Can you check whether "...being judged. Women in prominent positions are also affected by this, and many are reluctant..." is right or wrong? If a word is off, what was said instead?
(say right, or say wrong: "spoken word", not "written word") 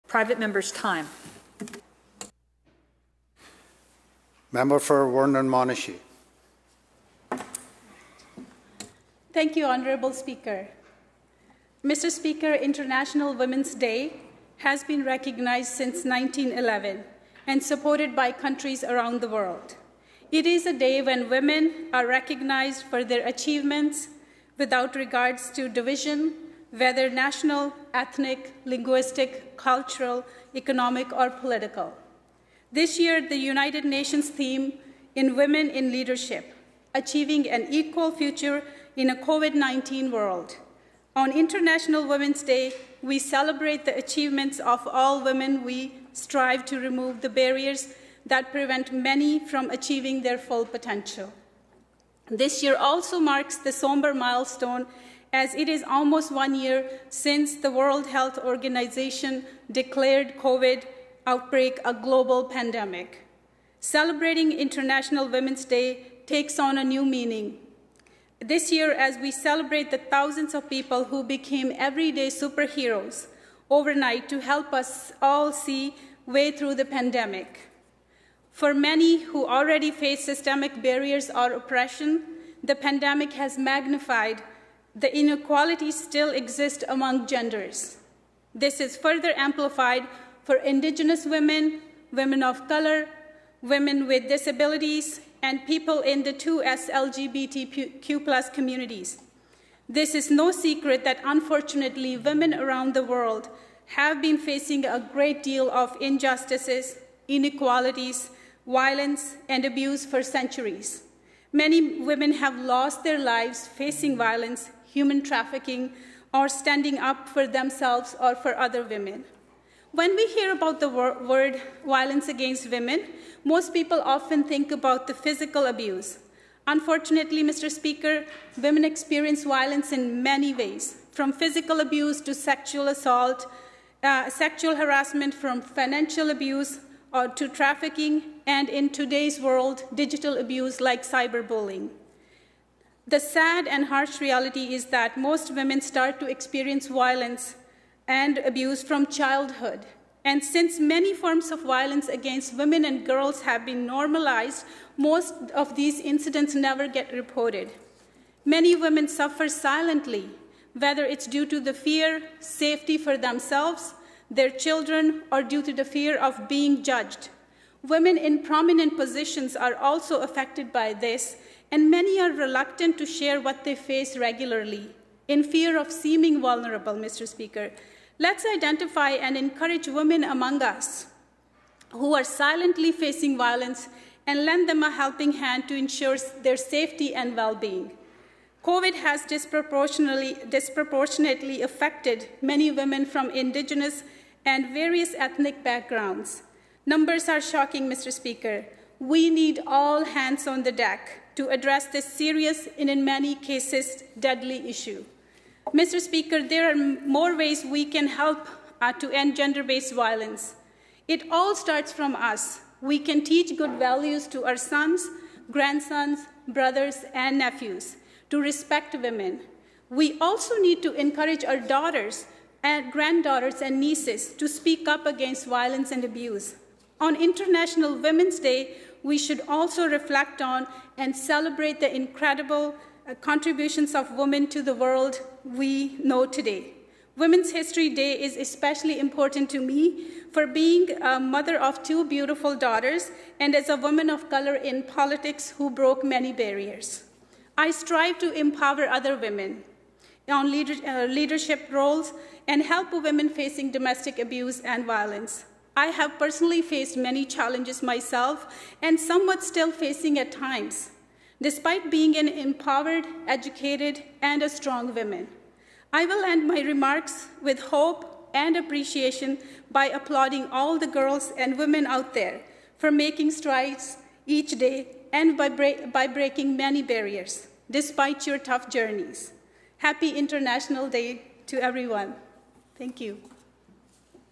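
right.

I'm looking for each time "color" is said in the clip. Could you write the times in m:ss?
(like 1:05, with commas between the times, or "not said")
1:32, 4:04.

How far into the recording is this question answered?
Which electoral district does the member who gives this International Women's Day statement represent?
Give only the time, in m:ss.
0:05.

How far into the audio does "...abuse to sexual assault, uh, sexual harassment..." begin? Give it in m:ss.
2:11.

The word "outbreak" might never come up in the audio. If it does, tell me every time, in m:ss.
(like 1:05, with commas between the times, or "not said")
1:01.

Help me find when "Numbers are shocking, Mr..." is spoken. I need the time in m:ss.
3:16.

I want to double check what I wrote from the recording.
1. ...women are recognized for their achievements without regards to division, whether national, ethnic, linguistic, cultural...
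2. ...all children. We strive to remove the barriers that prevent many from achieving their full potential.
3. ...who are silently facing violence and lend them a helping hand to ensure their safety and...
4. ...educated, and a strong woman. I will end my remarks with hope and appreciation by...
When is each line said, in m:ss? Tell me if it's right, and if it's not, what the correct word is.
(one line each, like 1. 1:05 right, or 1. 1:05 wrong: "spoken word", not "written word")
1. 0:21 right
2. 0:44 wrong: "women", not "children"
3. 3:01 right
4. 4:23 right.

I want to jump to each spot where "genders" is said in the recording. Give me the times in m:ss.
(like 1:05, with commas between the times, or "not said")
1:27, 3:29.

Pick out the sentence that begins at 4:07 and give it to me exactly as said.
I strive to empower other women on uh, leadership roles and help women facing domestic abuse and violence.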